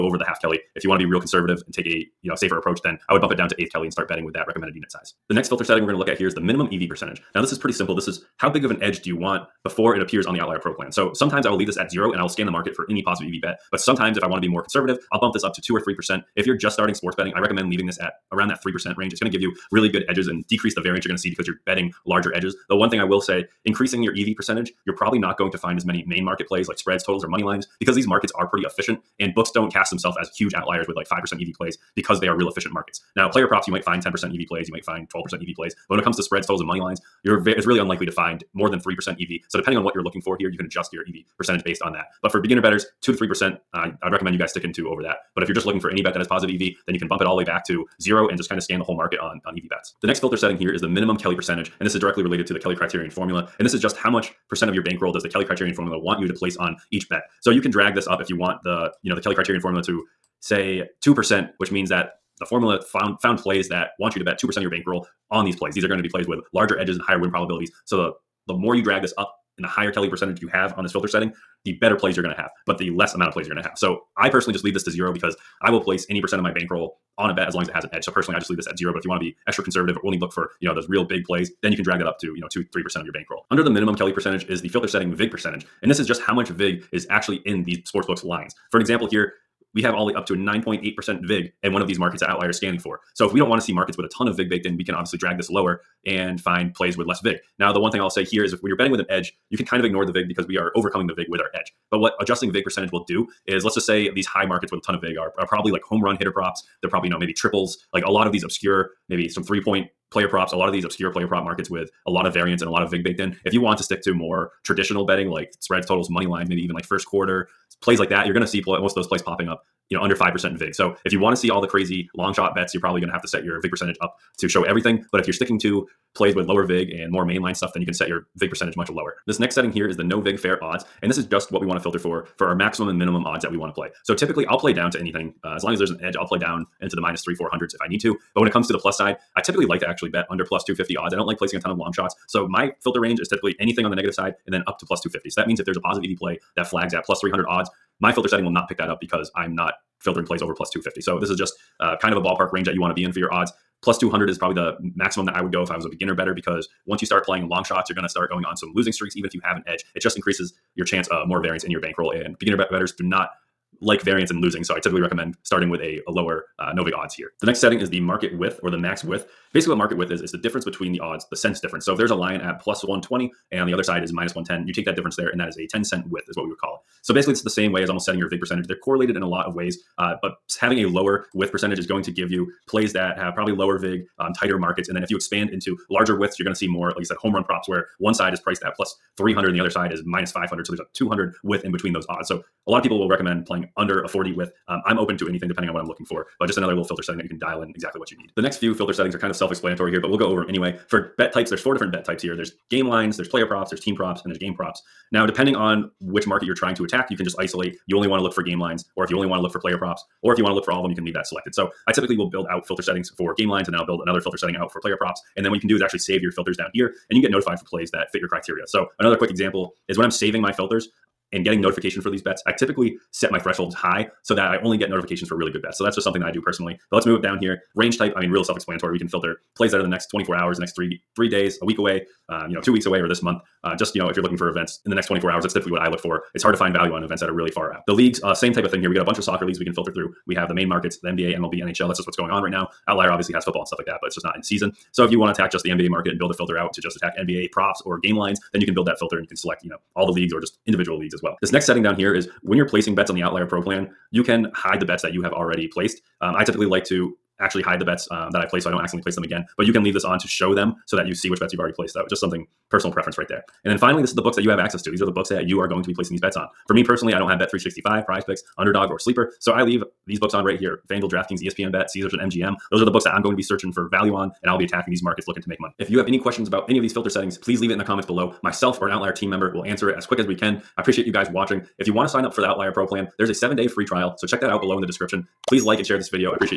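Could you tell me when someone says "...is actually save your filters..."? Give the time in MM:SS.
03:35.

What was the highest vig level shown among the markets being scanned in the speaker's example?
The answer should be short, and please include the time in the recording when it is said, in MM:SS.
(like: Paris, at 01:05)
9.8%, at 01:30.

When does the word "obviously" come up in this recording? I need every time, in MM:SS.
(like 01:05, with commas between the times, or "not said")
01:34, 04:03.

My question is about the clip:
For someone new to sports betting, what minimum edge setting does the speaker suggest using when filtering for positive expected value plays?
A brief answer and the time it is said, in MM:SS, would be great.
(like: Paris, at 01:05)
3%, at 00:18.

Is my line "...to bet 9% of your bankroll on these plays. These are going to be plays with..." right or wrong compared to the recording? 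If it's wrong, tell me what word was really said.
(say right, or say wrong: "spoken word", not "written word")
wrong: "2", not "9".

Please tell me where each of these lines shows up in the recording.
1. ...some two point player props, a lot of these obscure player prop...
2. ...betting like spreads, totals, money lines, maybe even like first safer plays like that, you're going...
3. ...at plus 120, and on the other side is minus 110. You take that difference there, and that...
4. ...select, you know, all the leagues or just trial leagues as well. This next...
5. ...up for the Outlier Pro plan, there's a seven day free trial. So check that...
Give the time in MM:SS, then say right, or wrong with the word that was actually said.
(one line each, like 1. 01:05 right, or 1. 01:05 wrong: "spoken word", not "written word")
1. 01:49 wrong: "three", not "two"
2. 01:55 wrong: "quarter", not "safer"
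3. 02:52 right
4. 04:09 wrong: "individual", not "trial"
5. 04:42 right.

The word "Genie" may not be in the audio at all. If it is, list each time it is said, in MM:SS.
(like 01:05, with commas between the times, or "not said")
not said.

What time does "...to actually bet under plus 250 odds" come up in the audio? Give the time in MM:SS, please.
02:19.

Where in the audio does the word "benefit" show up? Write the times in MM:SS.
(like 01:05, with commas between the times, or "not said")
not said.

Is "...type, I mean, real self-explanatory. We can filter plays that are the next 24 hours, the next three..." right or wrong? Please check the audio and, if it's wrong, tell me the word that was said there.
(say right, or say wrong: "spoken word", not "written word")
right.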